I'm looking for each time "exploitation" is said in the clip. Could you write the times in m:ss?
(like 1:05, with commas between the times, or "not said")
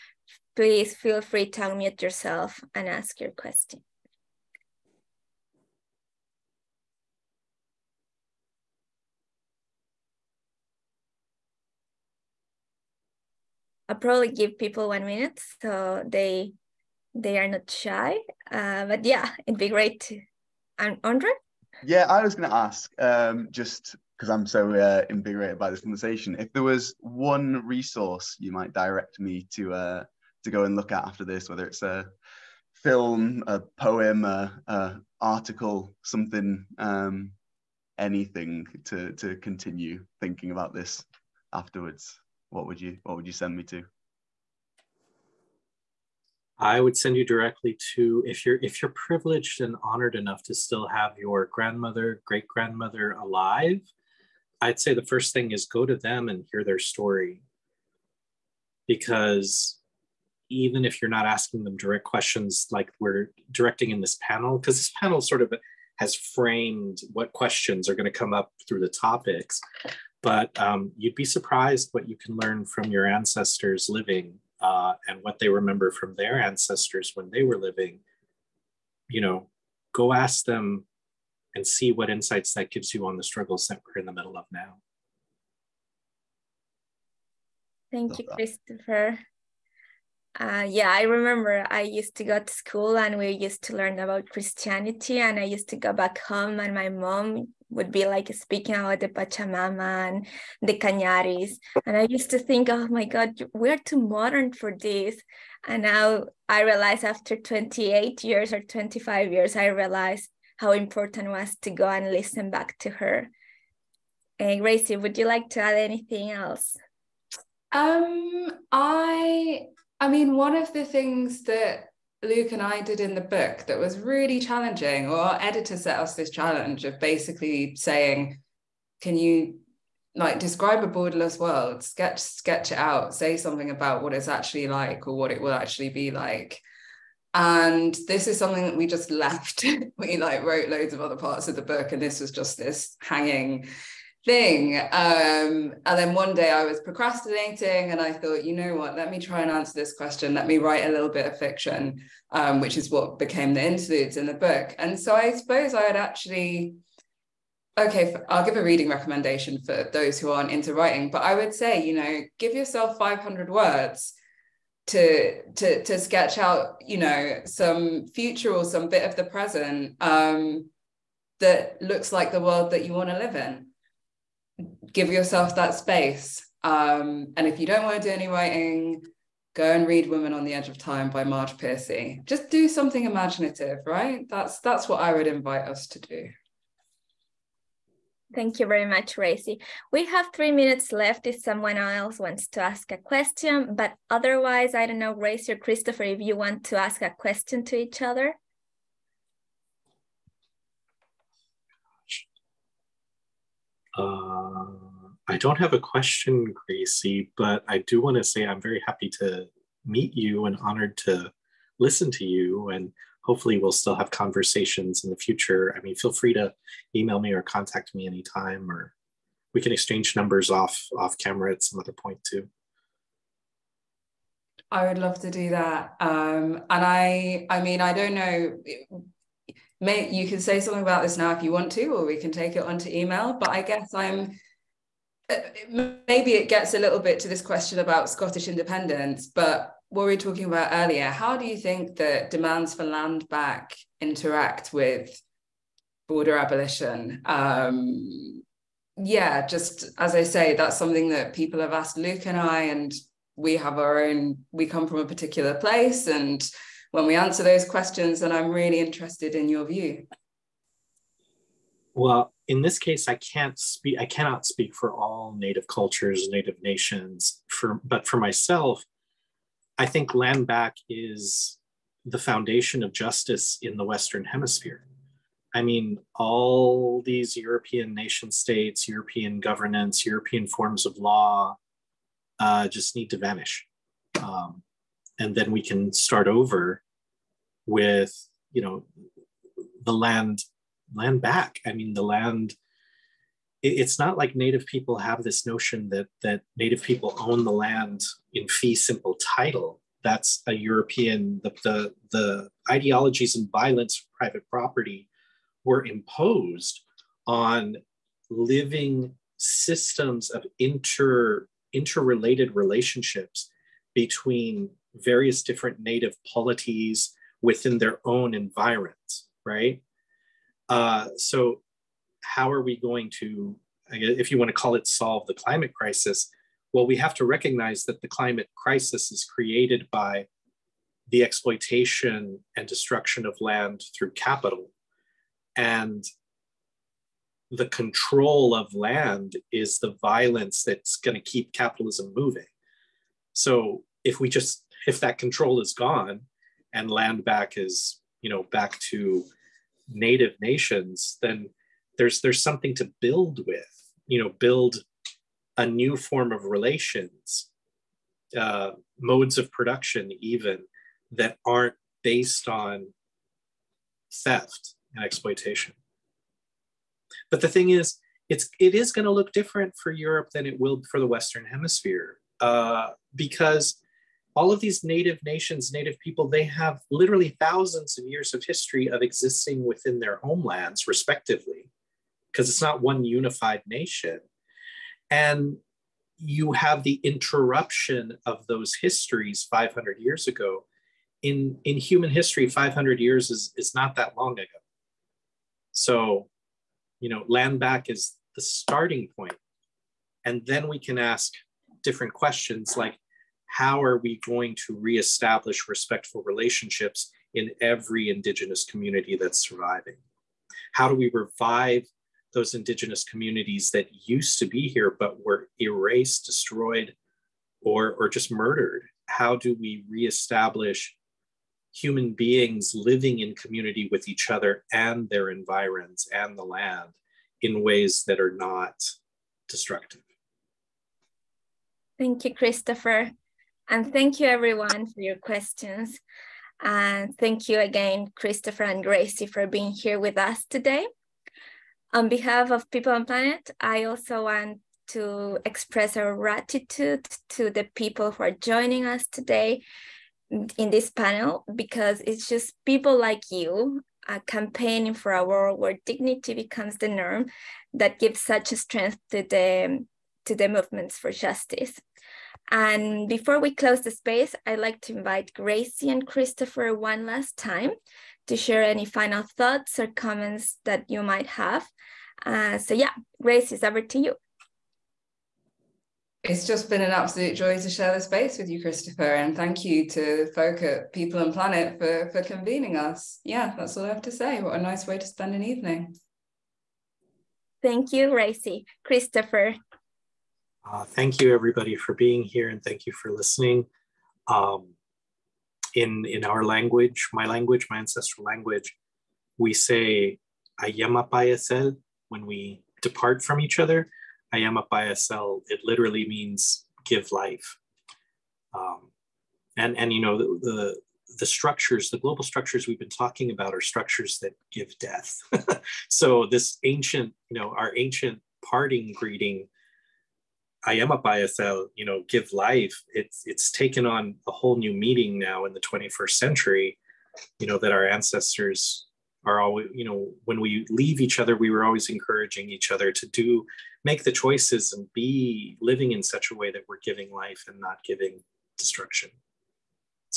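5:31, 6:05.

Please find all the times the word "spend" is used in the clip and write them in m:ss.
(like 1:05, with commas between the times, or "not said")
8:05.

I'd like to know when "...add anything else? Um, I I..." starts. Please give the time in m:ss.
1:55.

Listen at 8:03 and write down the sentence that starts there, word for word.
Yeah, that's all I have to say.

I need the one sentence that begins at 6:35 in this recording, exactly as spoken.
So, you know, land back is the starting point.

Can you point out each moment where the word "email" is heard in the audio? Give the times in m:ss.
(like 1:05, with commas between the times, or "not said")
3:36, 3:52.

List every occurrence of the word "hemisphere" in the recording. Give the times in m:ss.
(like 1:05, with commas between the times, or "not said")
4:34, 6:11.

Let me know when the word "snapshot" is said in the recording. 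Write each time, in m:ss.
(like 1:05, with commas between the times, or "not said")
not said.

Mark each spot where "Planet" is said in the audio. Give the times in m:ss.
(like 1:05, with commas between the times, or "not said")
7:23, 8:01.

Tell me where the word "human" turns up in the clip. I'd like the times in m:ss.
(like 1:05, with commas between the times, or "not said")
6:31, 7:01.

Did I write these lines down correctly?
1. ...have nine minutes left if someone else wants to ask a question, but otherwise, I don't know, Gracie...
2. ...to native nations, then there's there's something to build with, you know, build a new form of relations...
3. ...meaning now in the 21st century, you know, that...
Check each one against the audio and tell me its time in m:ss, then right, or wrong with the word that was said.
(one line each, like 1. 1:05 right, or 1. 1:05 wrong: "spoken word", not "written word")
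1. 3:10 wrong: "three", not "nine"
2. 5:48 right
3. 8:44 right.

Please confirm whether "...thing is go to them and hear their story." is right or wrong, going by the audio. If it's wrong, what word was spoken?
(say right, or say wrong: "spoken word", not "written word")
right.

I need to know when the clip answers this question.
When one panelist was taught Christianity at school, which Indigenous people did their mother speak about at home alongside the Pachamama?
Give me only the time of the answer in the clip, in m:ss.
1:40.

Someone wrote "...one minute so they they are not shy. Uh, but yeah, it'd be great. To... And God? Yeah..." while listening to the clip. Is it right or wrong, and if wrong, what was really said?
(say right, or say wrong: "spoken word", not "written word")
wrong: "Andre", not "God".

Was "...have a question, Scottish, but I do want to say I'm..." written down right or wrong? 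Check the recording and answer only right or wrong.
wrong.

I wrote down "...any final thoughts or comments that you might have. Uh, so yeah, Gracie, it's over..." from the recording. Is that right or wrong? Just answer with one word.
right.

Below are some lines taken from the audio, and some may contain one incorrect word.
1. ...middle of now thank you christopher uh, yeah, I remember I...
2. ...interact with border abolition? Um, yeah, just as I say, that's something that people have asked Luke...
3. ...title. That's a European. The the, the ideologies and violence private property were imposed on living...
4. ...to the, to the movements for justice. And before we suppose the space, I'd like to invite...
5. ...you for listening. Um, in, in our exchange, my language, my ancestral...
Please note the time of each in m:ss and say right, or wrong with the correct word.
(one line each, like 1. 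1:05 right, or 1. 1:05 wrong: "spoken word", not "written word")
1. 1:24 right
2. 4:04 right
3. 4:59 right
4. 7:39 wrong: "close", not "suppose"
5. 8:12 wrong: "language", not "exchange".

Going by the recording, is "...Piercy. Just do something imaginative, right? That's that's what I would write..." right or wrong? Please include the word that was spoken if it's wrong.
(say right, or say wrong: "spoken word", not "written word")
wrong: "invite", not "write".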